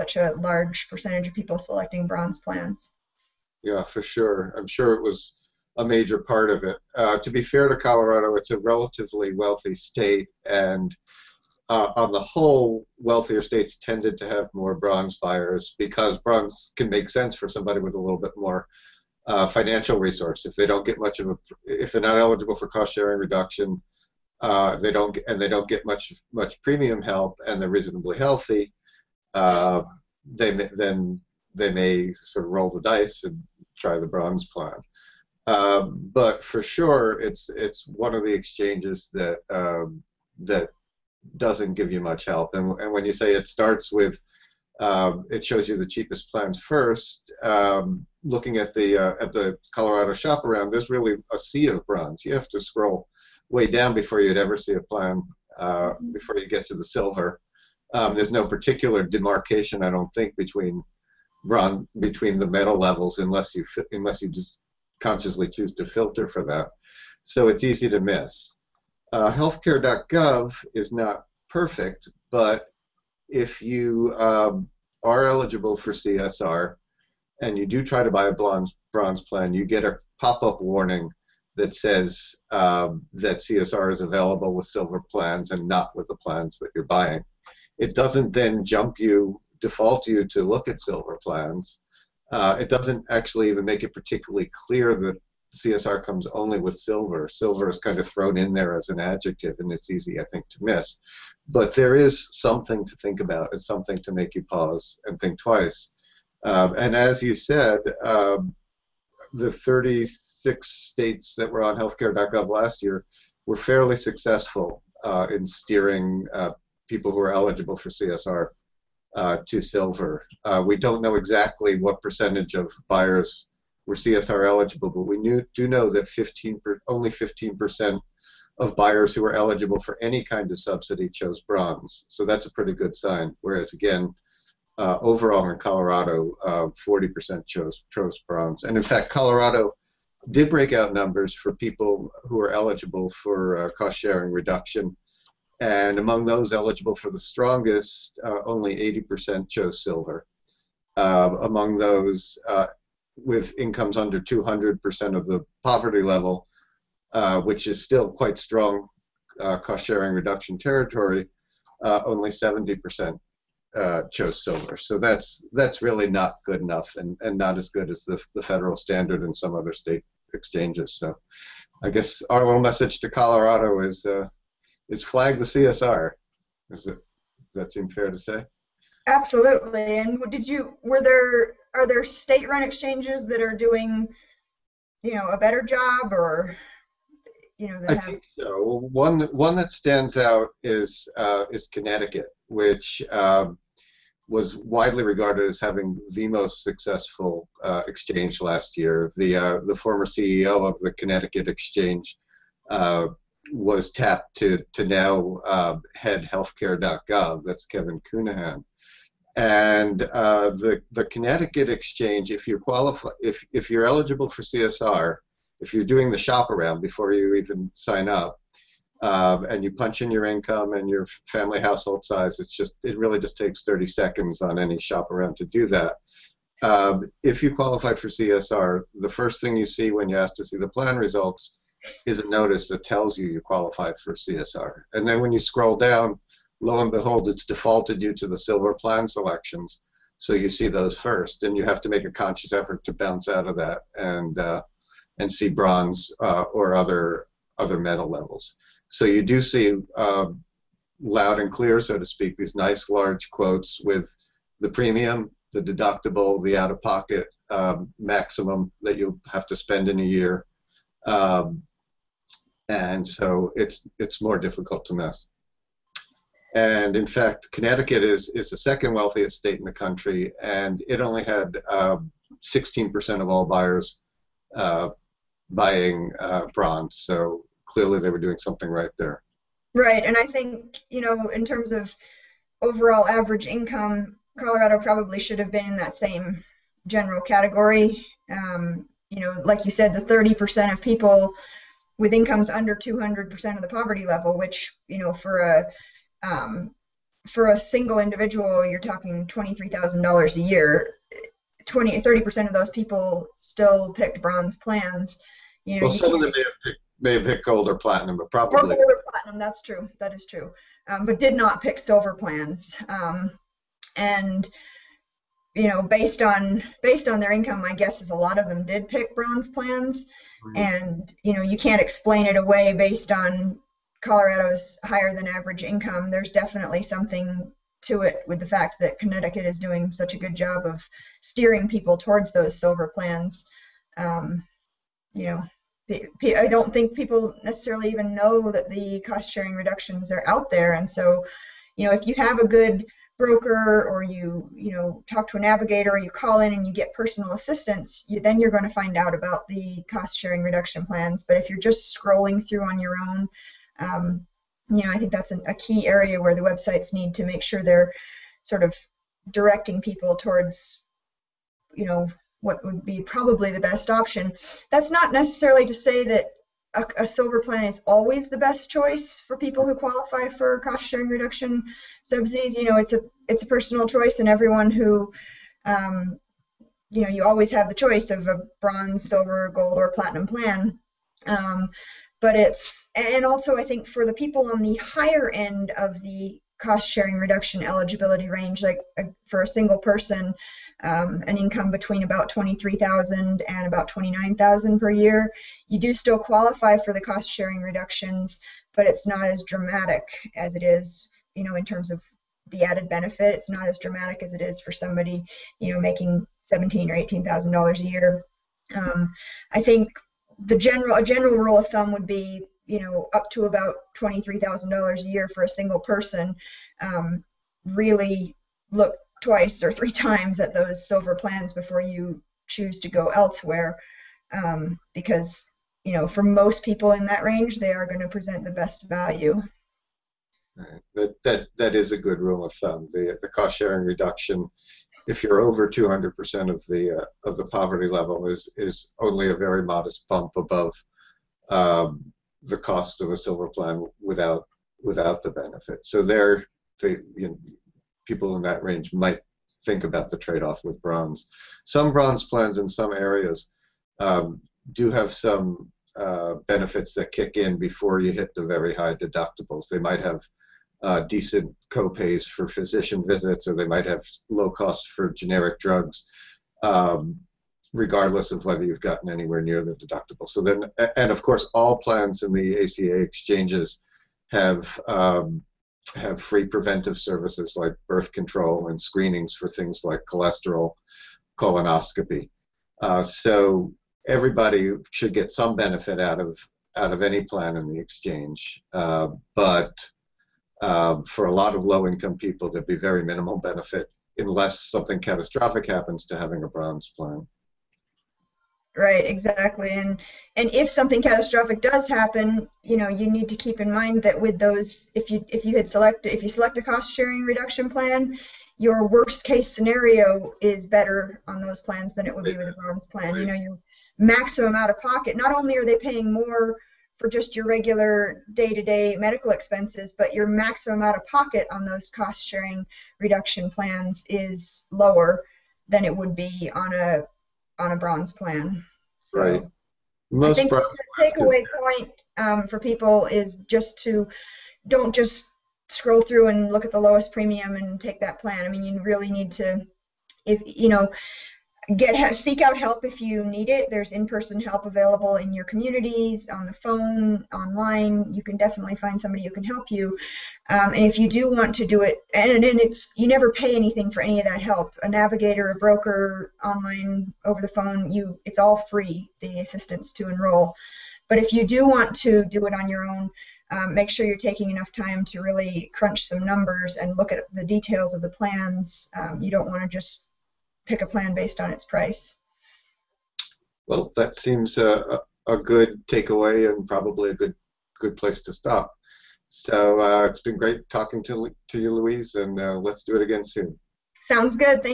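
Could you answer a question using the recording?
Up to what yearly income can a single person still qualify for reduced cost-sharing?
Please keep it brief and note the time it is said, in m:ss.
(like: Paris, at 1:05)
29,000, at 6:33.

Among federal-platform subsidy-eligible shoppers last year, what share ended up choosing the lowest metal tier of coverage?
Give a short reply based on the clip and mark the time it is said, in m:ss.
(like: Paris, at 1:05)
15%, at 2:06.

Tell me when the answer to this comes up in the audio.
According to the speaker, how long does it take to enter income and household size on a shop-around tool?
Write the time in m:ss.
3:43.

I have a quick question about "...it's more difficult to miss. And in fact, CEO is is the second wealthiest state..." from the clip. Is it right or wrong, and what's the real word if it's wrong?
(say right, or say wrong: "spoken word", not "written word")
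wrong: "Connecticut", not "CEO".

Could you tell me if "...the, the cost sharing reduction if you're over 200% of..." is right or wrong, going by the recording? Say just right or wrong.
right.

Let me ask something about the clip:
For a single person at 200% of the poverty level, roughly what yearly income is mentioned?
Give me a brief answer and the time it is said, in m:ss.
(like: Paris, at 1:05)
$23,000, at 4:59.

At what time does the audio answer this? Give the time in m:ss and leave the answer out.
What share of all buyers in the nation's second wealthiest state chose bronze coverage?
4:32.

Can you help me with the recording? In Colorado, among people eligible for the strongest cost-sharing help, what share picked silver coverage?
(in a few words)
80%.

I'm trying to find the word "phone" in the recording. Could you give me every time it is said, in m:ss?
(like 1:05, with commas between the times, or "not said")
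9:06, 9:17.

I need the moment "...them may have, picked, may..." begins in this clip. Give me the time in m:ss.
5:06.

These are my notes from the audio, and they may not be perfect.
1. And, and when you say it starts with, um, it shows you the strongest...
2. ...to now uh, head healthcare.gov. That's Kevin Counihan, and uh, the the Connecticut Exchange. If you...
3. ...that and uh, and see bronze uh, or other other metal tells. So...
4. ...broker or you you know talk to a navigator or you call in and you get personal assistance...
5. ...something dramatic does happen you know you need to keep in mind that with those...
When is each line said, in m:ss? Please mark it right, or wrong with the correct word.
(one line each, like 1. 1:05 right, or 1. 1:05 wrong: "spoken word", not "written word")
1. 0:42 wrong: "cheapest", not "strongest"
2. 3:24 right
3. 4:03 wrong: "levels", not "tells"
4. 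5:43 right
5. 8:20 wrong: "catastrophic", not "dramatic".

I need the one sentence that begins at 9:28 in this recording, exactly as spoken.
Um, you don't want to just pick a plan based on its price.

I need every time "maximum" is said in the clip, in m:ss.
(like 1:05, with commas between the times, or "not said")
4:17, 8:33, 8:40.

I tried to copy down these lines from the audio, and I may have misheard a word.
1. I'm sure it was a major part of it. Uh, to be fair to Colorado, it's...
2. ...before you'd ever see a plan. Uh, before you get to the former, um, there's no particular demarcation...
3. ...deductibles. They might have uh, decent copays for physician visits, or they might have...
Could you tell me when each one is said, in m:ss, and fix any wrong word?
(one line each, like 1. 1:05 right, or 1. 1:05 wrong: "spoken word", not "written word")
1. 0:04 right
2. 0:53 wrong: "silver", not "former"
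3. 7:38 right.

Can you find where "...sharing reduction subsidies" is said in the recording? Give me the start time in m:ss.
6:10.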